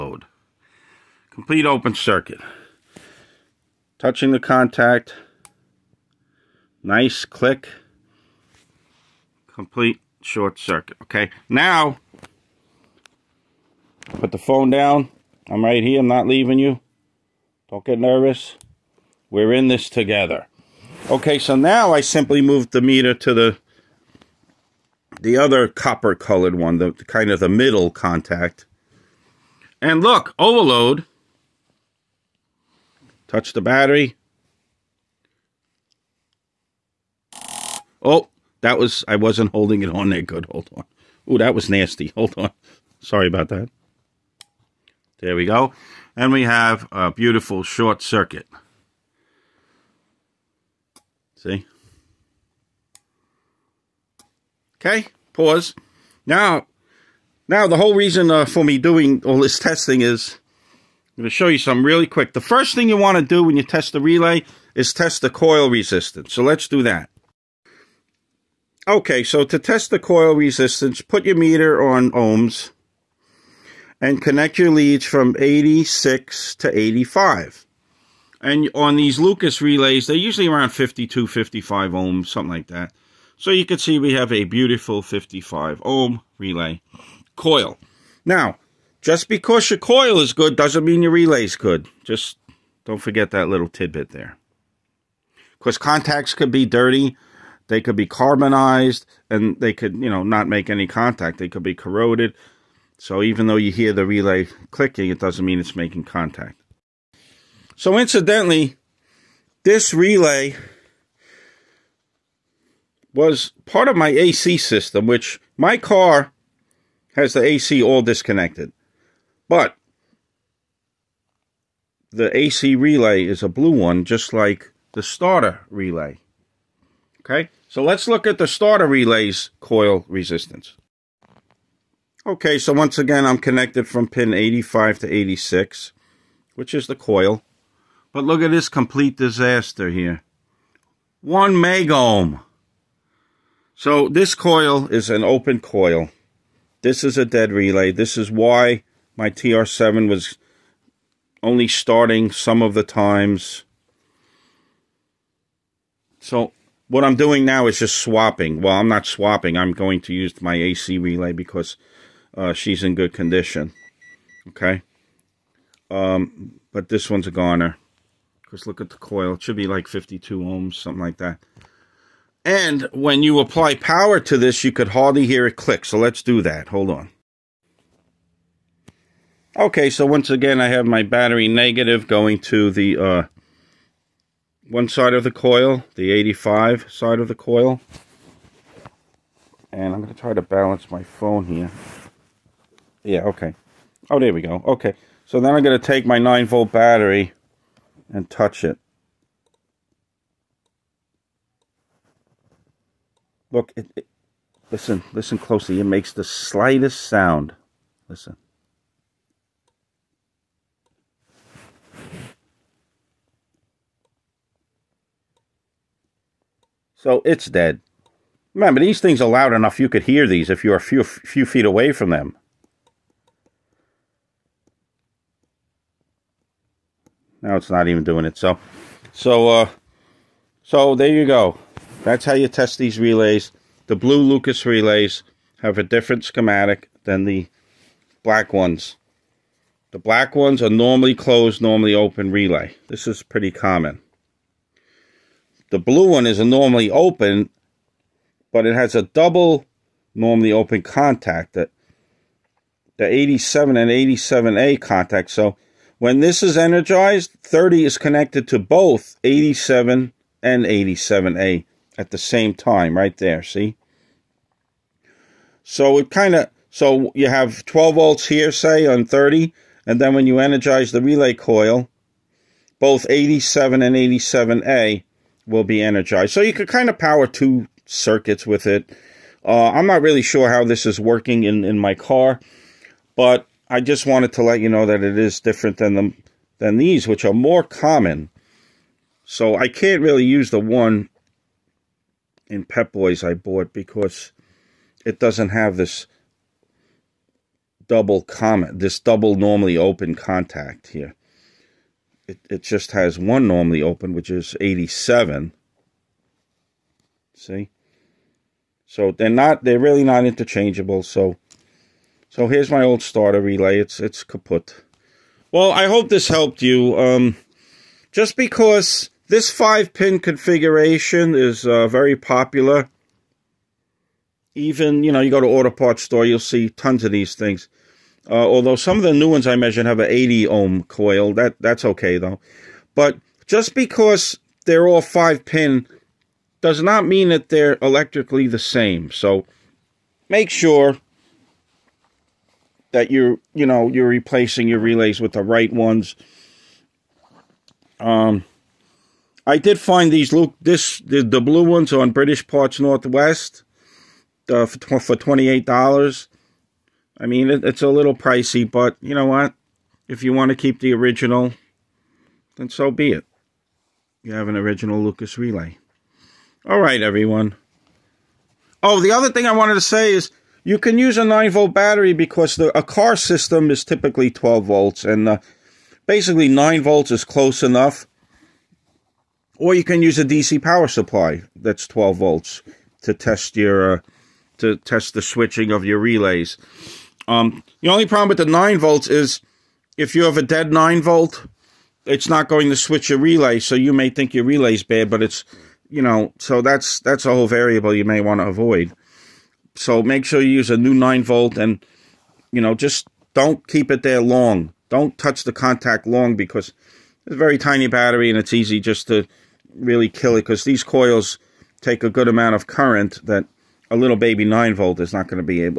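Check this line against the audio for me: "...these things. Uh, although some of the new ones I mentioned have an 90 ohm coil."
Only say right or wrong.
wrong.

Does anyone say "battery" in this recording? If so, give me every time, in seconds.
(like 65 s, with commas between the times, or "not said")
33 s, 181 s, 196 s, 371 s, 407 s.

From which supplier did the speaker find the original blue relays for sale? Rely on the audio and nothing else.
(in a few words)
British Parts Northwest.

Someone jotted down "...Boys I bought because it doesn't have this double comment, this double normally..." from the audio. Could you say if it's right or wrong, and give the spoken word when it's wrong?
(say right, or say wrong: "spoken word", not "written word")
right.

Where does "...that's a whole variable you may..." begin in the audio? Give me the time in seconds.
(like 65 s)
396 s.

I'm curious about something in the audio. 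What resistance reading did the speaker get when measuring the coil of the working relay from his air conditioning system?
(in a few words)
55 ohms.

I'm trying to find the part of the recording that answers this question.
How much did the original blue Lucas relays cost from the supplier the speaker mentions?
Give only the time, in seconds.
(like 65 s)
355 s.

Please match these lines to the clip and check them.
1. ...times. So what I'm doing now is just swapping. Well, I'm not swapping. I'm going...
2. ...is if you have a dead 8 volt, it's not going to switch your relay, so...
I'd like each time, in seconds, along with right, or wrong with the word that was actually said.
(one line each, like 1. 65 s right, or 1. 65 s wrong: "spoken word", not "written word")
1. 152 s right
2. 389 s wrong: "9", not "8".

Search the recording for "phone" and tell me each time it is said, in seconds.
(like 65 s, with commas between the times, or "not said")
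14 s, 191 s.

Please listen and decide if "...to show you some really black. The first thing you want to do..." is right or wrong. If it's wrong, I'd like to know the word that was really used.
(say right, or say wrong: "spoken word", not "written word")
wrong: "quick", not "black".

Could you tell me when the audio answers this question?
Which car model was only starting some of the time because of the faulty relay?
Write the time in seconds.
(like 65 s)
149 s.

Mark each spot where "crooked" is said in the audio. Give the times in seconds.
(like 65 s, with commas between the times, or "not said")
not said.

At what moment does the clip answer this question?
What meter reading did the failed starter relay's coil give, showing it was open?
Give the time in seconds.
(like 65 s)
141 s.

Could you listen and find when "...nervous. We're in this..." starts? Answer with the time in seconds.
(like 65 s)
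17 s.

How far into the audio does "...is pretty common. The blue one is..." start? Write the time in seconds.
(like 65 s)
243 s.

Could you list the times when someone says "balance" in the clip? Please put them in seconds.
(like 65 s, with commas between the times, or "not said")
190 s.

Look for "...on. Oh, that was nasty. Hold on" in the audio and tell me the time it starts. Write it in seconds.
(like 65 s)
40 s.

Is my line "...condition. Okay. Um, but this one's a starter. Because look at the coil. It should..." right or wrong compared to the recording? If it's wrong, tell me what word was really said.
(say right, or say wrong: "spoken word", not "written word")
wrong: "goner", not "starter".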